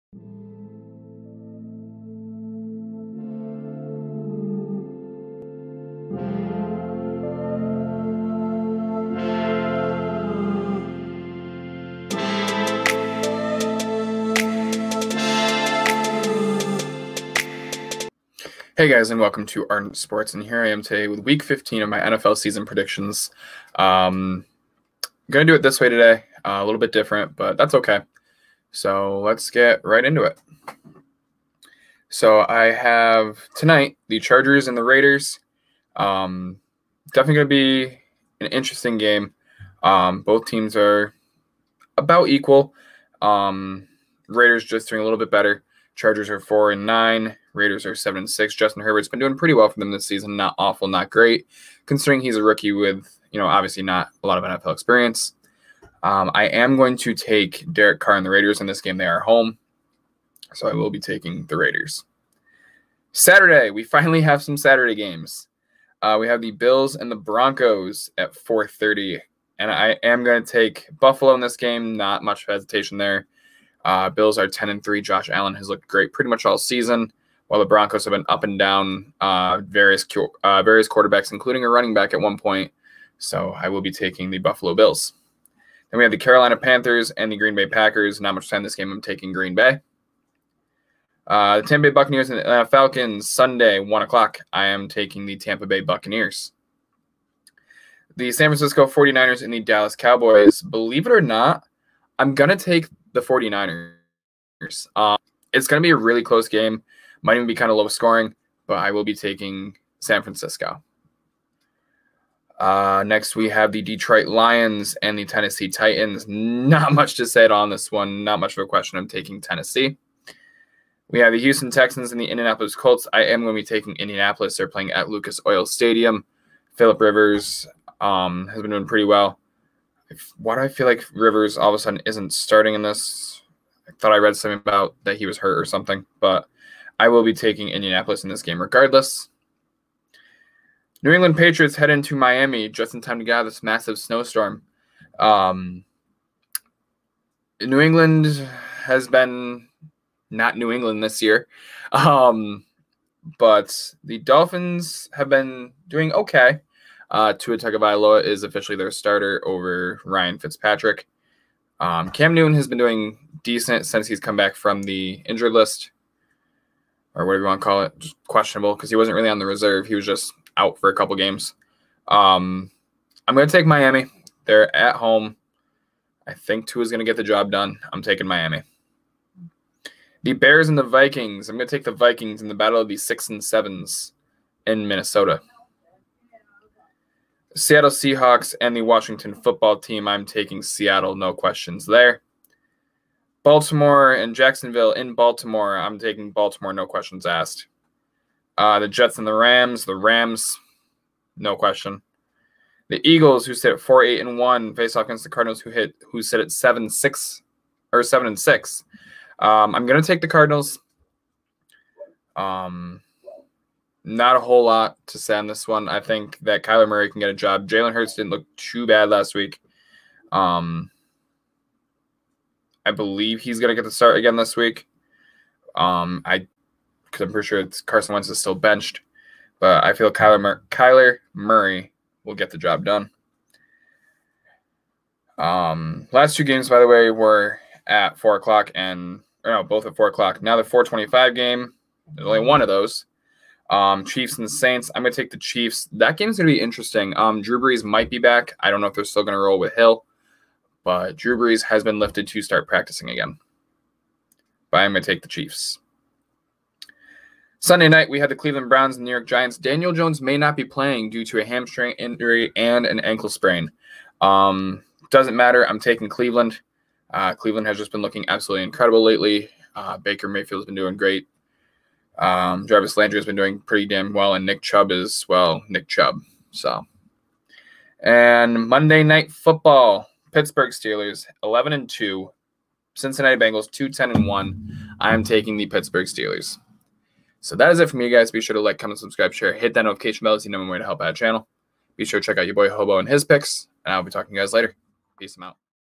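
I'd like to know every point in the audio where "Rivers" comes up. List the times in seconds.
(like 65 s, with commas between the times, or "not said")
127 s, 131 s.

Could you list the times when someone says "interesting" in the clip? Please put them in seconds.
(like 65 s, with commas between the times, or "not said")
38 s, 246 s.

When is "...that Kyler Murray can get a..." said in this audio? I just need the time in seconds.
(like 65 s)
216 s.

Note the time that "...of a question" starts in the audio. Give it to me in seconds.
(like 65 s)
118 s.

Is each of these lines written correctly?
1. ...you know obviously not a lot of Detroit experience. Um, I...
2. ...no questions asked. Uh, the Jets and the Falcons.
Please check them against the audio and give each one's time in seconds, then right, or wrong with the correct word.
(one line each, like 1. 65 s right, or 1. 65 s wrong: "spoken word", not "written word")
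1. 53 s wrong: "NFL", not "Detroit"
2. 196 s wrong: "Rams", not "Falcons".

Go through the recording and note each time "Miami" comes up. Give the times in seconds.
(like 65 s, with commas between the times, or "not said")
142 s, 173 s, 178 s.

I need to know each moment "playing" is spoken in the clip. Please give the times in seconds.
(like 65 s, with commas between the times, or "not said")
124 s, 260 s.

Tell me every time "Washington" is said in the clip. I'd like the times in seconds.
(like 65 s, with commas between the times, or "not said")
188 s.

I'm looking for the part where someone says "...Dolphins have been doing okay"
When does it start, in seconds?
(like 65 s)
154 s.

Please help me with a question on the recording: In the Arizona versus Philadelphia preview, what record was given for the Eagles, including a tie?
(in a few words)
4-8-1.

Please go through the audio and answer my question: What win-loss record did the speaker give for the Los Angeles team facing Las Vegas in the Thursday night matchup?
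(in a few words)
4-9.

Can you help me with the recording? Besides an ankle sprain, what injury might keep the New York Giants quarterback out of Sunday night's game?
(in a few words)
Hamstring injury.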